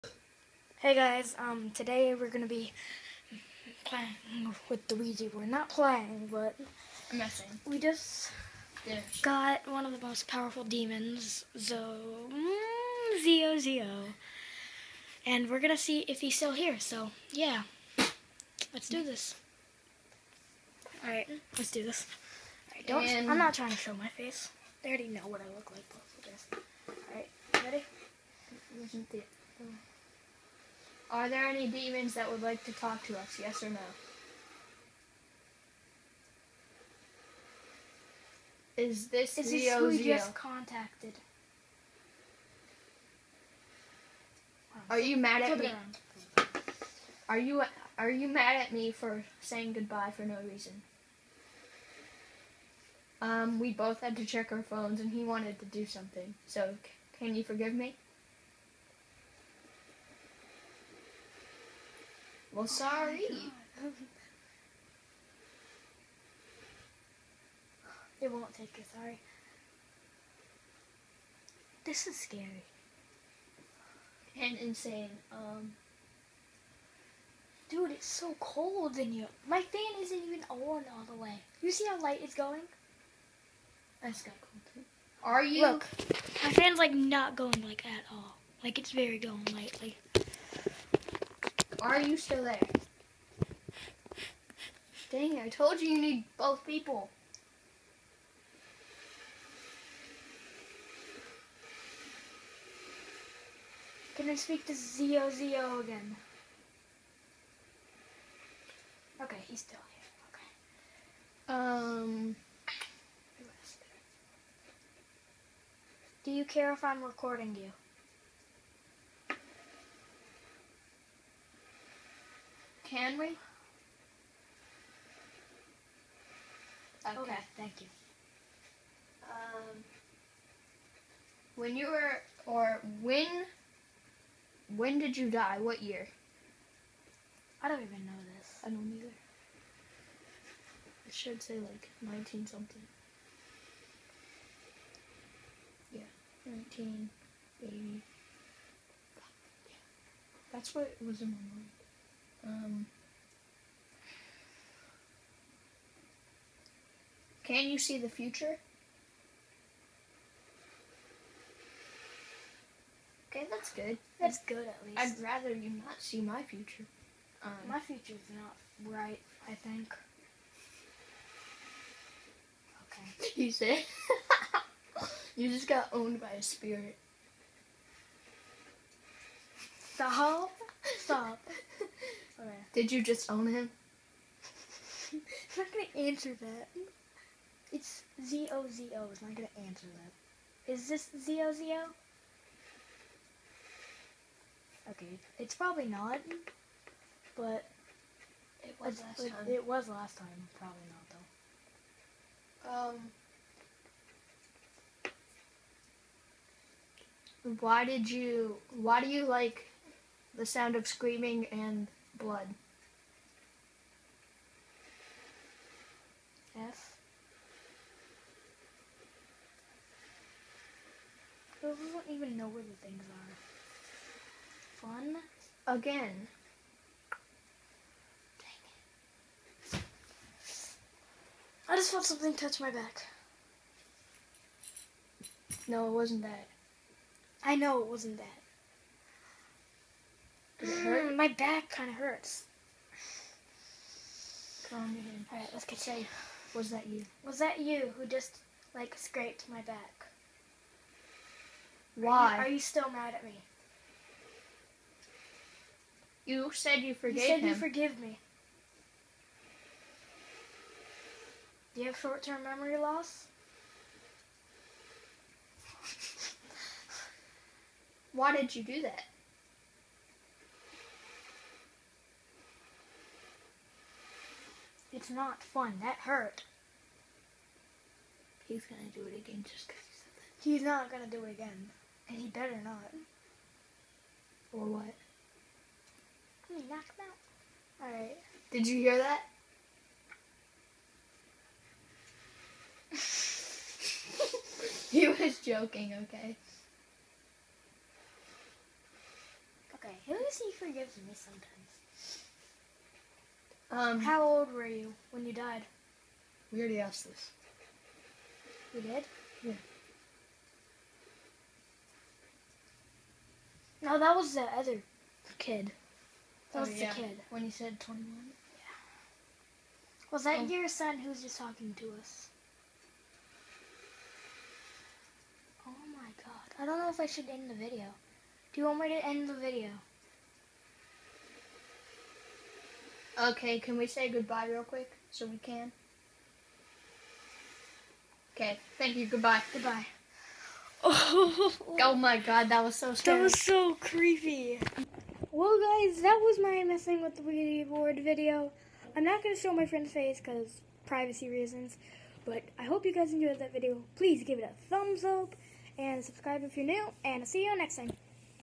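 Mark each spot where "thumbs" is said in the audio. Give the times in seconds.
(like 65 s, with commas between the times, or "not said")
354 s.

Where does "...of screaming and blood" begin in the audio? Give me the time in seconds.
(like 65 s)
210 s.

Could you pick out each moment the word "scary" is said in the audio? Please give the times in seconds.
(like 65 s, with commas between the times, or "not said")
72 s, 342 s.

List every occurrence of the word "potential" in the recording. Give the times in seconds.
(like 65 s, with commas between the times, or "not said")
not said.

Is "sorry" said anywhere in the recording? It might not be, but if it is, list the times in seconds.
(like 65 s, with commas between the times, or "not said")
62 s, 68 s.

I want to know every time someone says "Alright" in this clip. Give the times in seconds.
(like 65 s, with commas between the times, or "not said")
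245 s, 287 s.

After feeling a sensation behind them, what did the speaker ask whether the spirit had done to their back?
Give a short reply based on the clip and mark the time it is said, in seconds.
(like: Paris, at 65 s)
scraped, at 248 s.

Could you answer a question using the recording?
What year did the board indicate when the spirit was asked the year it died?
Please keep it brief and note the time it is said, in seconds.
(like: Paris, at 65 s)
1980, at 146 s.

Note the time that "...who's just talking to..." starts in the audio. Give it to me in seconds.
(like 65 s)
320 s.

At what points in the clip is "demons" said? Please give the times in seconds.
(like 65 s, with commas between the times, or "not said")
10 s, 31 s.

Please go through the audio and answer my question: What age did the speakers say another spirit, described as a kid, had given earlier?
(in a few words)
21.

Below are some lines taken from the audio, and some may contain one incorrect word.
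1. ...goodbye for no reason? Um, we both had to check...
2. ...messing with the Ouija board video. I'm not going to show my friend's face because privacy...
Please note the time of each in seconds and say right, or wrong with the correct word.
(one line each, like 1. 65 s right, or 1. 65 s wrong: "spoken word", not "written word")
1. 49 s right
2. 346 s right.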